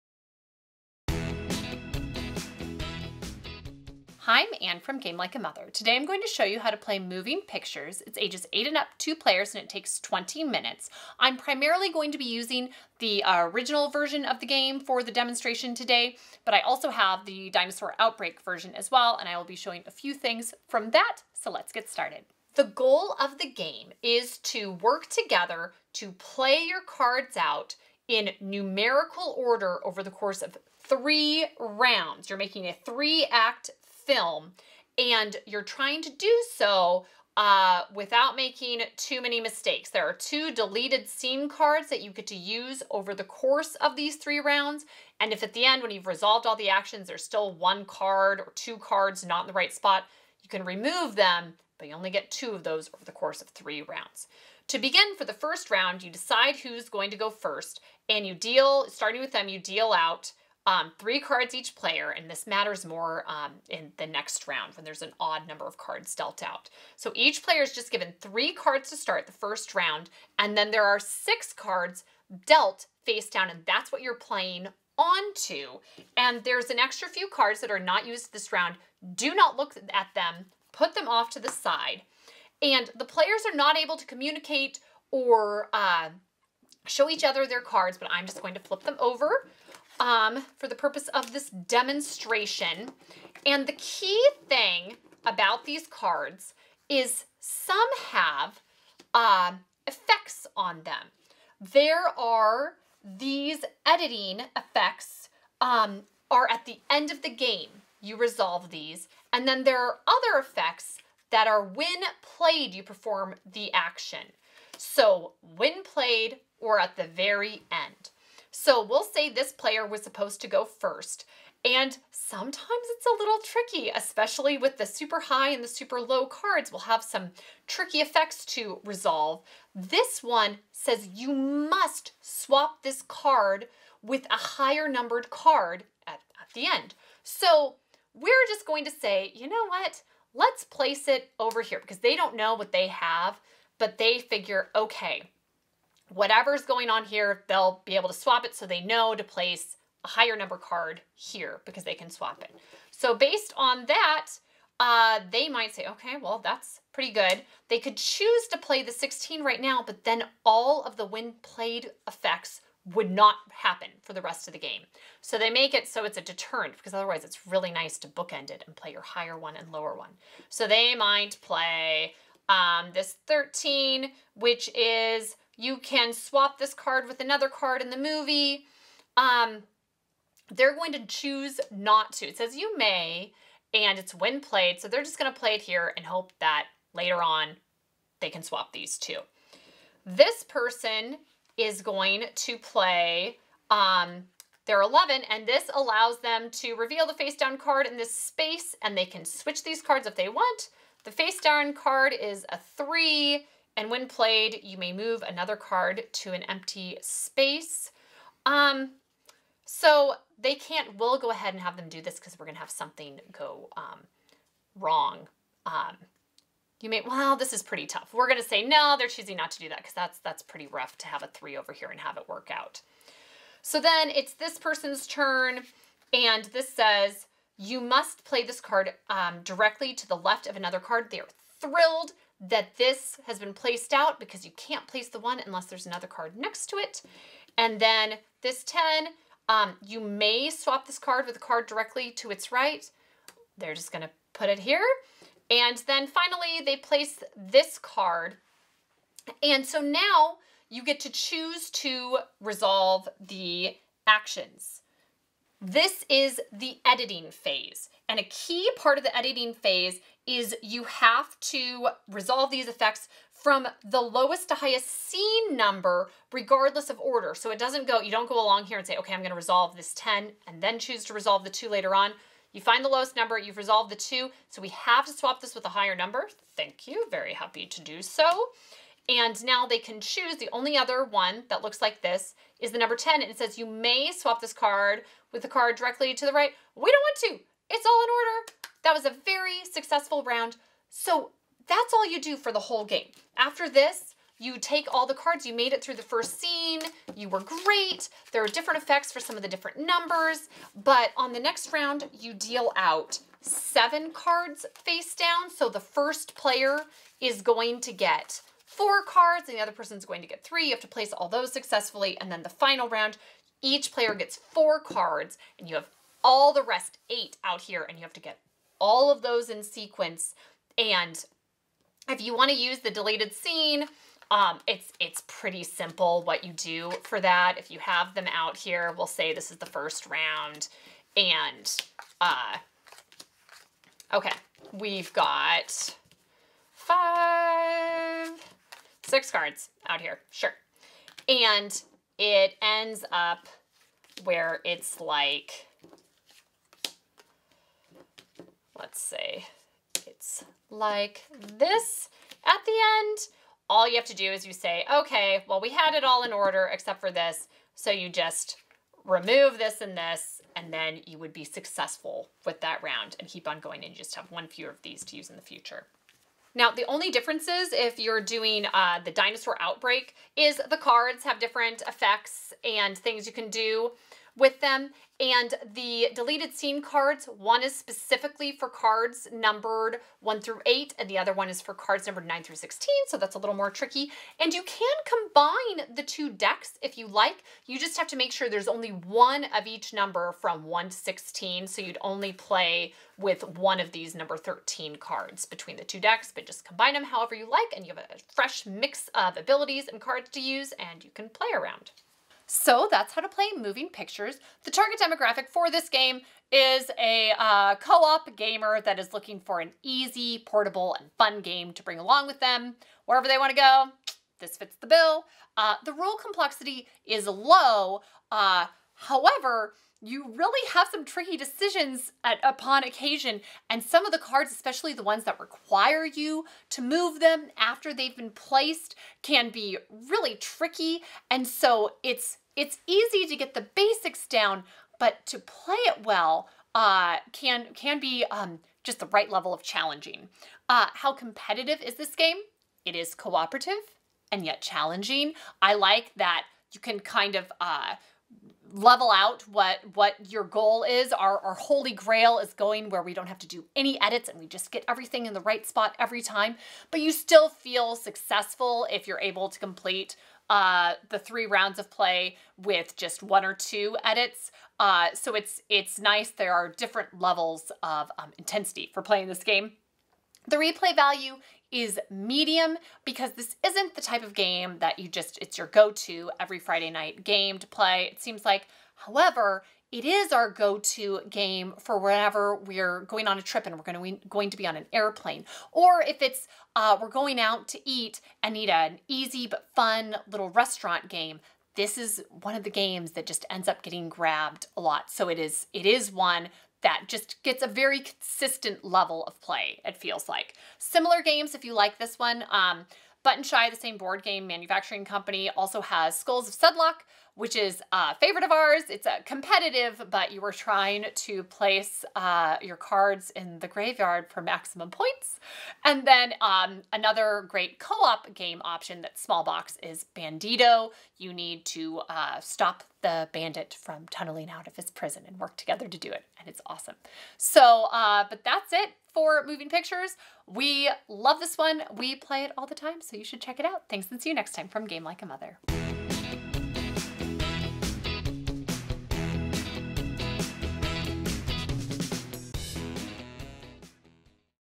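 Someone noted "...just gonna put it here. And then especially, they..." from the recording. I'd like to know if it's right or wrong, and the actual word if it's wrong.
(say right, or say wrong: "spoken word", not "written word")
wrong: "finally", not "especially".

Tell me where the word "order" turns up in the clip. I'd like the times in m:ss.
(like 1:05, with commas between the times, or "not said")
0:29, 4:26, 4:48, 5:56.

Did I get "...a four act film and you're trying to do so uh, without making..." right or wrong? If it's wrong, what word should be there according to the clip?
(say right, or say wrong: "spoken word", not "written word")
wrong: "three", not "four".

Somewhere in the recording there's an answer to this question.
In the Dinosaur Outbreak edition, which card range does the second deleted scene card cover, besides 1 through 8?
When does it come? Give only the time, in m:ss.
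6:22.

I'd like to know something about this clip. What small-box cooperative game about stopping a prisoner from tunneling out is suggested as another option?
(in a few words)
Bandito.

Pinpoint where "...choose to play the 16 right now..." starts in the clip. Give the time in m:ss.
2:37.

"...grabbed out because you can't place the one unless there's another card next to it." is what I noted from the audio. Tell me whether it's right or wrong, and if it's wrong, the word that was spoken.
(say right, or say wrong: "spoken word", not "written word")
wrong: "placed", not "grabbed".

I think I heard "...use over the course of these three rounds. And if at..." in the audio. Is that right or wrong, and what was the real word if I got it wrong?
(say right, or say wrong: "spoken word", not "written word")
right.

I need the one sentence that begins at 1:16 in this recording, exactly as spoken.
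And there's an extra few cards that are not used this round.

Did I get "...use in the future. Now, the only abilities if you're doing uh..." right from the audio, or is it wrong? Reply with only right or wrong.
wrong.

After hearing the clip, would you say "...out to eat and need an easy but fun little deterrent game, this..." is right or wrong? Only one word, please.
wrong.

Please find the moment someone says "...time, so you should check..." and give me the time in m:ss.
8:52.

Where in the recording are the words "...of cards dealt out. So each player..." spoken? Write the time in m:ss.
1:05.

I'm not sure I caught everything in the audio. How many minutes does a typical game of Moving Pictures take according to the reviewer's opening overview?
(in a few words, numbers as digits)
20 minutes.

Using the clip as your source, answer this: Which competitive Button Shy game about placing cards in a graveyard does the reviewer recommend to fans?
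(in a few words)
Skulls of Sedlec.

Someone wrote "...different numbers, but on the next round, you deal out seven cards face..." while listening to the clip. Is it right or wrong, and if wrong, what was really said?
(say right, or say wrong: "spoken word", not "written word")
right.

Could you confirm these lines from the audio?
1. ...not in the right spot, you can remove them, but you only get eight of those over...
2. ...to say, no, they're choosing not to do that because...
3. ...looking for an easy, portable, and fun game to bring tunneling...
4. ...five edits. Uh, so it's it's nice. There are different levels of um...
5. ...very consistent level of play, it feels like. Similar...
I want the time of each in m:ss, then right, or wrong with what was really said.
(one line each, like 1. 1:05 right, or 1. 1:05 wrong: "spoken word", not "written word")
1. 0:49 wrong: "two", not "eight"
2. 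3:38 right
3. 6:49 wrong: "along", not "tunneling"
4. 7:43 wrong: "two", not "five"
5. 8:17 right.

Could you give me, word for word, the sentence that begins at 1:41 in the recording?
There are these editing effects um, are at the end of the game.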